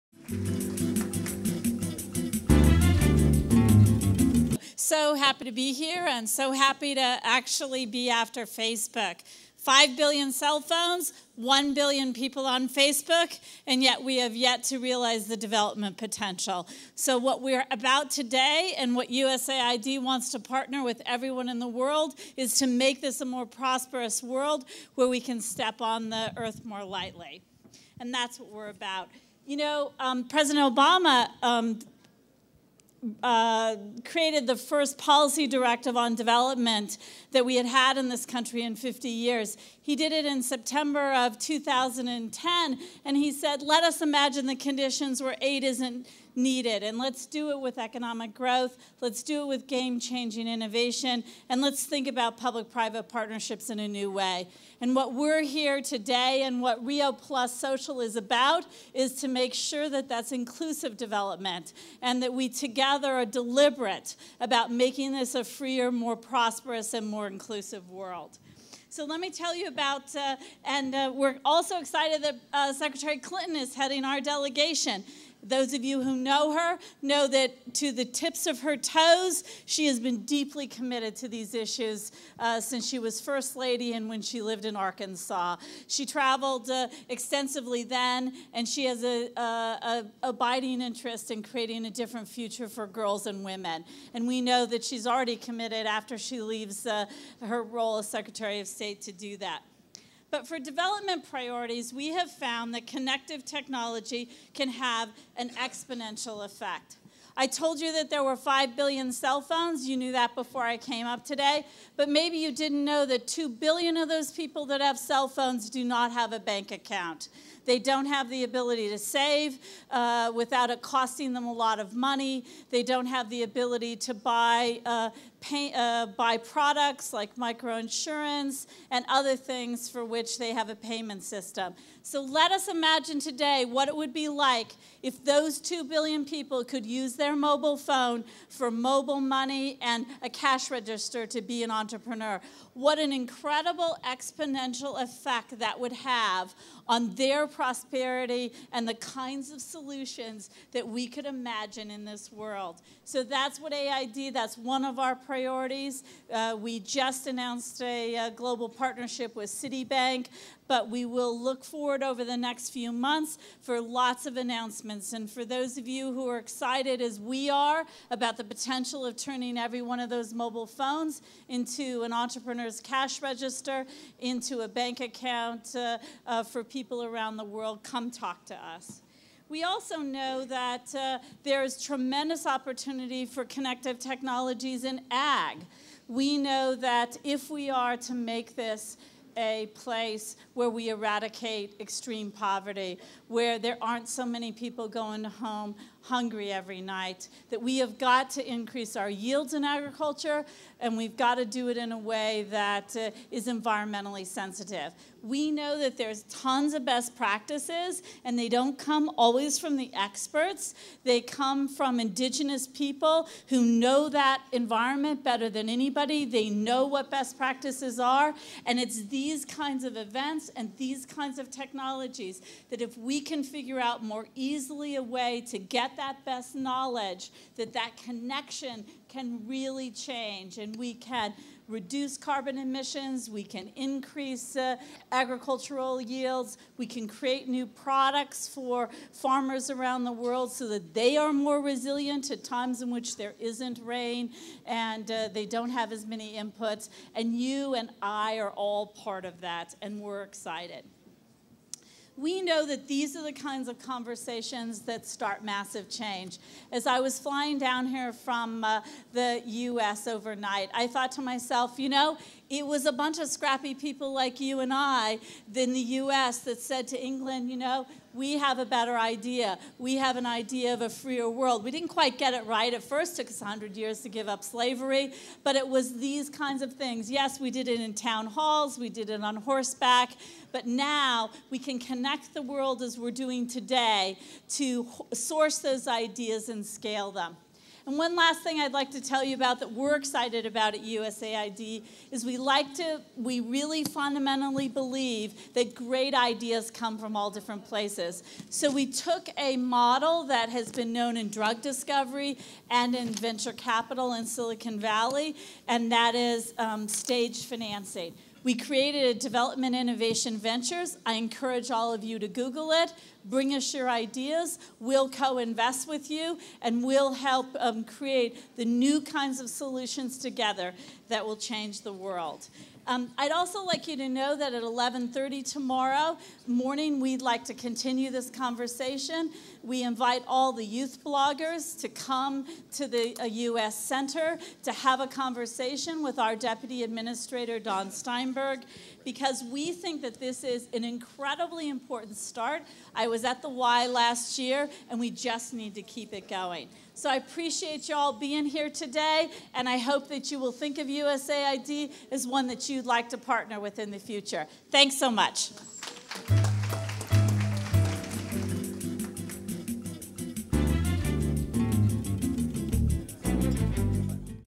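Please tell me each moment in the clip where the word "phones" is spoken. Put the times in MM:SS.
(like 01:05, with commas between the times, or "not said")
00:10, 01:49, 01:55, 02:17, 02:50.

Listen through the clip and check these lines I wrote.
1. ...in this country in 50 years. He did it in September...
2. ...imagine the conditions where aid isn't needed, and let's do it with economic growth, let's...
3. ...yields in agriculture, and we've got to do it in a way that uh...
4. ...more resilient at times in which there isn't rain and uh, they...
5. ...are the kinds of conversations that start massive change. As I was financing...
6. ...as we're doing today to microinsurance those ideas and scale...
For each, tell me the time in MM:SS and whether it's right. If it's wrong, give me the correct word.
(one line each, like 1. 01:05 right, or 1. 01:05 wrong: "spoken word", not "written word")
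1. 00:37 right
2. 00:44 right
3. 03:19 right
4. 04:01 right
5. 04:13 wrong: "flying", not "financing"
6. 04:42 wrong: "source", not "microinsurance".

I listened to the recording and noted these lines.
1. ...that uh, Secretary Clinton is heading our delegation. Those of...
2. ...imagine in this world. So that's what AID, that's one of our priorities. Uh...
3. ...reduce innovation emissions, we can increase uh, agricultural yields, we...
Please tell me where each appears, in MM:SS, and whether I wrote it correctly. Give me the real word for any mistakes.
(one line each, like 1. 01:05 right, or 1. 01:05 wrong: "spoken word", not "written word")
1. 01:12 right
2. 02:31 right
3. 03:51 wrong: "carbon", not "innovation".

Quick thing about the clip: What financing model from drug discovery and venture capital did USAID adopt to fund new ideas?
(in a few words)
stage financing.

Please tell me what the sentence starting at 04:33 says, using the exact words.
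It took us 100 years to give up slavery, but it was these kinds of things.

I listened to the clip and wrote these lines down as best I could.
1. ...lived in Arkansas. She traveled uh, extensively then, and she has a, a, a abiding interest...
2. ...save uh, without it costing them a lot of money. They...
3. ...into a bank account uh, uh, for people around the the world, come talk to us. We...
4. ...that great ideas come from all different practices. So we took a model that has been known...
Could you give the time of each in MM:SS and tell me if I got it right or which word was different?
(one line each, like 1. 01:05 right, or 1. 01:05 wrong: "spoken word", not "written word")
1. 01:24 right
2. 01:58 right
3. 02:54 right
4. 04:55 wrong: "places", not "practices".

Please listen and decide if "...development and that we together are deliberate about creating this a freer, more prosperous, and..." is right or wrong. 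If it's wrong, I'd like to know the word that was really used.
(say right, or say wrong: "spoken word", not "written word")
wrong: "making", not "creating".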